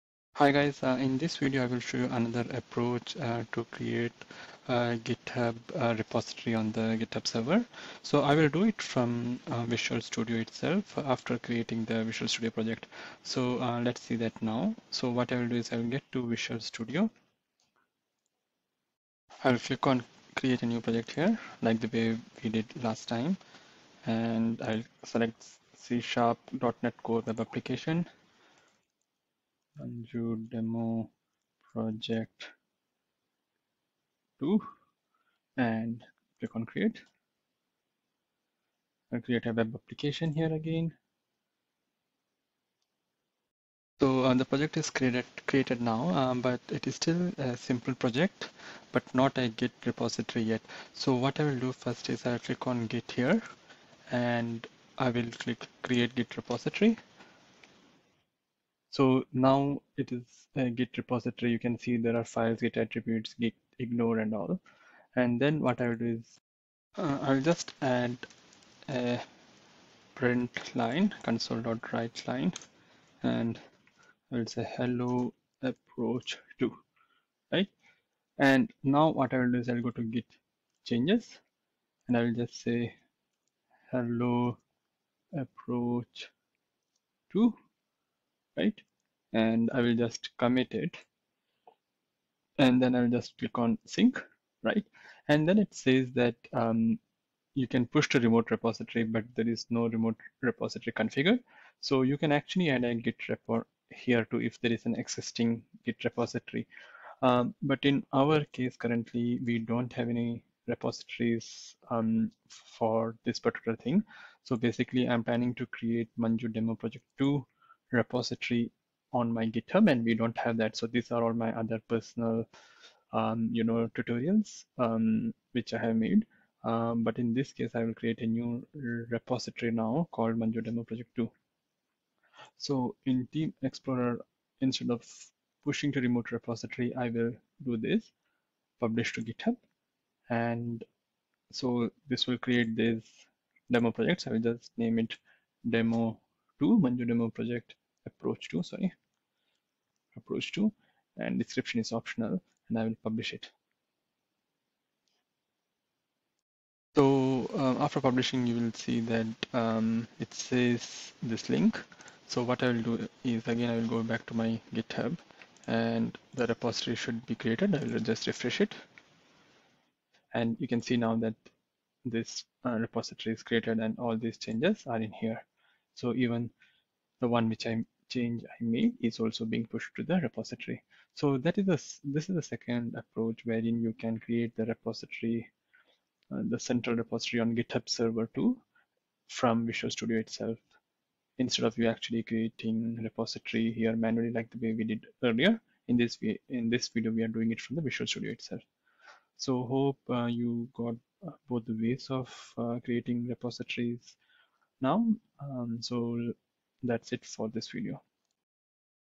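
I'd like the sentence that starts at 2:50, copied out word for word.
And you can see now that this uh, repository is created and all these changes are in here.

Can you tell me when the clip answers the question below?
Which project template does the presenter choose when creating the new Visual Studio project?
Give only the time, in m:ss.
0:25.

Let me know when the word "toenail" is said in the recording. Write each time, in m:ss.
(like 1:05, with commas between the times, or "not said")
not said.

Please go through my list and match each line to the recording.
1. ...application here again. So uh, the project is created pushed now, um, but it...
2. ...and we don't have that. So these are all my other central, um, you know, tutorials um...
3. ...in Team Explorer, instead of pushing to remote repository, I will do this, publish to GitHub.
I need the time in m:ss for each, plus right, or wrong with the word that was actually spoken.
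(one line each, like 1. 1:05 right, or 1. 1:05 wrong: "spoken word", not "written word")
1. 0:39 wrong: "created", not "pushed"
2. 1:59 wrong: "personal", not "central"
3. 2:13 right.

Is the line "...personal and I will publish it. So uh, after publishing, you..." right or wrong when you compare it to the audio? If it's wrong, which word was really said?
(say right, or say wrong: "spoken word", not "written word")
wrong: "optional", not "personal".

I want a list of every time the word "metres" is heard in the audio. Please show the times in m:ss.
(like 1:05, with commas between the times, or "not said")
not said.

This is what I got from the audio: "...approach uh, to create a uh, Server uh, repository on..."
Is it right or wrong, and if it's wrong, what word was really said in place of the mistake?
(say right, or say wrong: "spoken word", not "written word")
wrong: "GitHub", not "Server".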